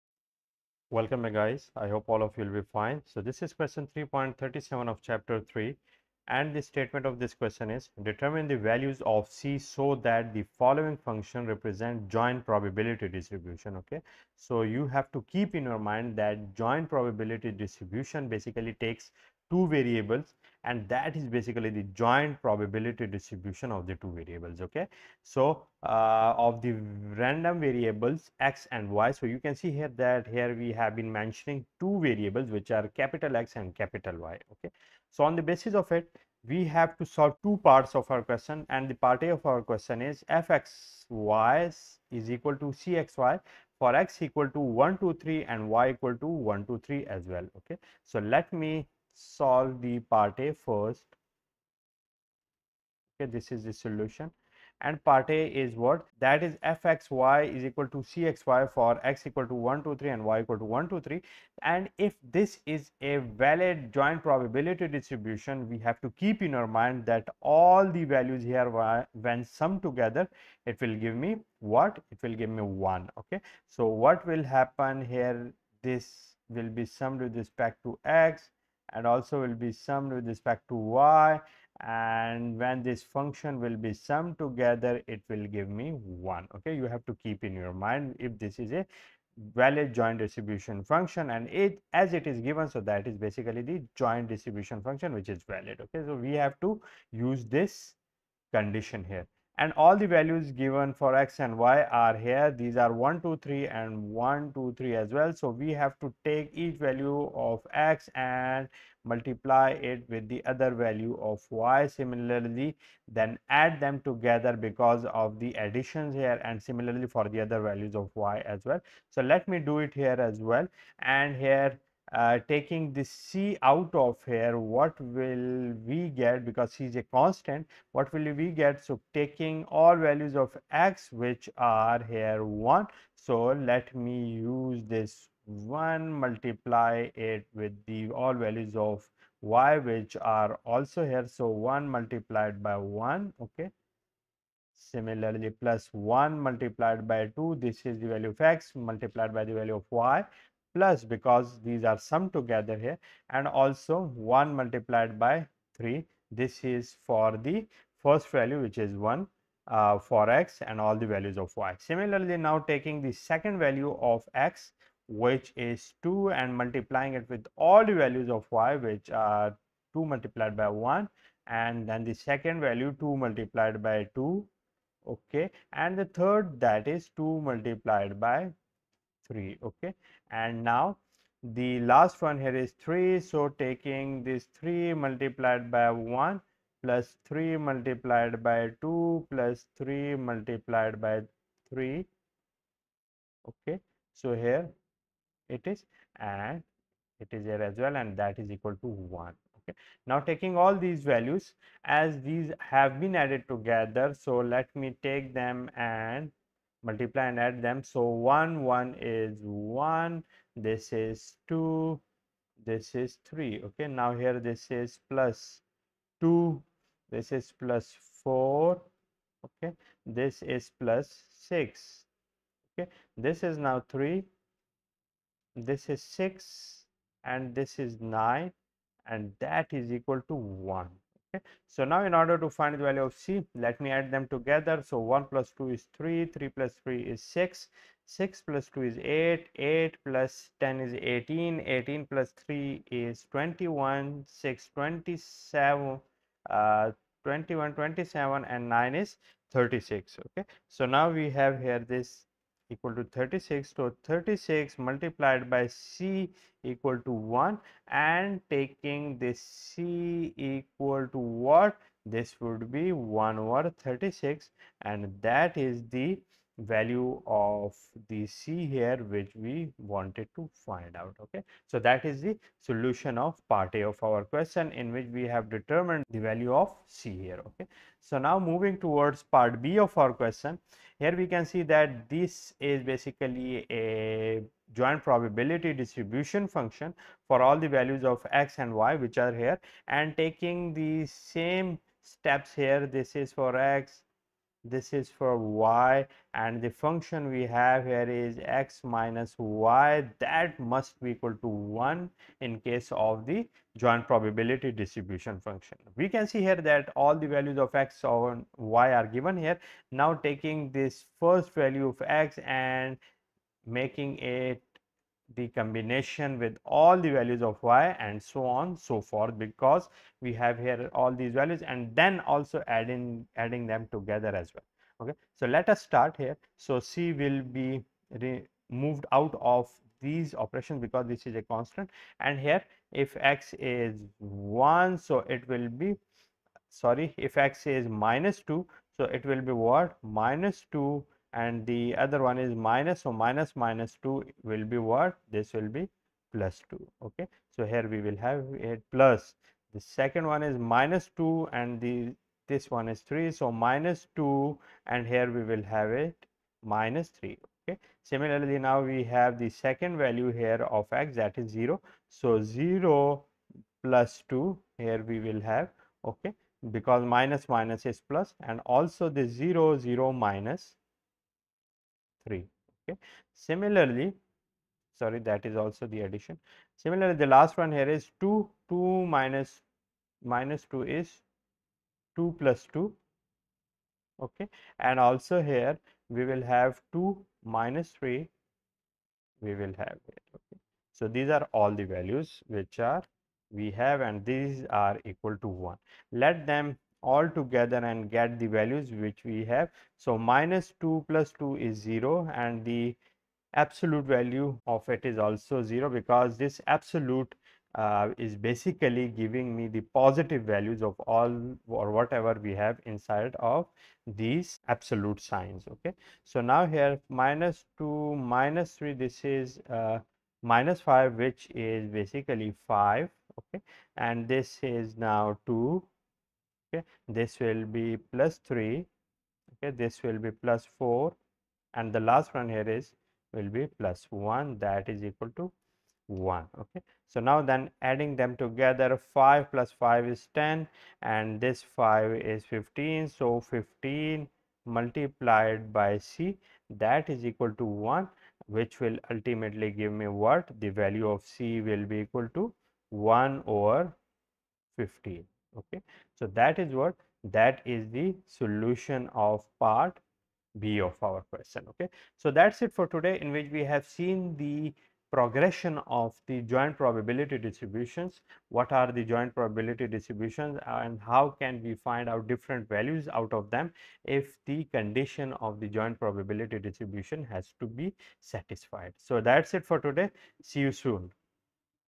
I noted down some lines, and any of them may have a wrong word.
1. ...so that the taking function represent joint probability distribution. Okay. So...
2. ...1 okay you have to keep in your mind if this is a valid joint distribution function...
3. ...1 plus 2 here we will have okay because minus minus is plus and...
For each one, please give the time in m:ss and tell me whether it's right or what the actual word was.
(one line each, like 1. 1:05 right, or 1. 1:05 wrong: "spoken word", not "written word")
1. 0:09 wrong: "following", not "taking"
2. 1:25 right
3. 6:02 wrong: "0", not "1".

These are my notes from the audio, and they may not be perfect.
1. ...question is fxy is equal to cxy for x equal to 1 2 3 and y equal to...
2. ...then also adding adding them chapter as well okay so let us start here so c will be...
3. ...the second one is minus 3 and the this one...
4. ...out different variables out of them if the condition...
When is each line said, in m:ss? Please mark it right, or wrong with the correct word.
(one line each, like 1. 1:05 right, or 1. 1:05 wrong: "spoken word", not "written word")
1. 0:39 right
2. 5:21 wrong: "together", not "chapter"
3. 5:49 wrong: "2", not "3"
4. 7:52 wrong: "values", not "variables".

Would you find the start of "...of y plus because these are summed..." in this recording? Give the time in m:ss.
2:29.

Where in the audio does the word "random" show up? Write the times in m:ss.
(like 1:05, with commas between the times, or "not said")
0:27.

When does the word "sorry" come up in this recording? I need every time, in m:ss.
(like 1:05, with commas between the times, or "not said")
5:36, 6:15.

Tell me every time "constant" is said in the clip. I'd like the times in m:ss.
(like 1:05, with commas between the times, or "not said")
2:07, 5:31.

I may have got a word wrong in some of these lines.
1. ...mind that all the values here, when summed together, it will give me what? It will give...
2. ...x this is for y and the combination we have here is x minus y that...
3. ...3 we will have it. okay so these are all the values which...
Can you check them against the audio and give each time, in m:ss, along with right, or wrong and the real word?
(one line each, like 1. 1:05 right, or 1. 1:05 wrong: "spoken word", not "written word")
1. 1:06 right
2. 4:53 wrong: "function", not "combination"
3. 6:27 right.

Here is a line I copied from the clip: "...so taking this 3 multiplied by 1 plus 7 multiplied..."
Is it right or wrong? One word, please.
wrong.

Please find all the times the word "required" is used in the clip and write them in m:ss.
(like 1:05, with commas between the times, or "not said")
not said.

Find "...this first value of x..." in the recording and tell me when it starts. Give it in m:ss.
5:10.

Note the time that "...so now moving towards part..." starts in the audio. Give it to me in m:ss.
4:37.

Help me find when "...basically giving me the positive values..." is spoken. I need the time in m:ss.
6:48.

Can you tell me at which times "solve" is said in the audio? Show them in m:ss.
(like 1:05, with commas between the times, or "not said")
0:37, 0:49.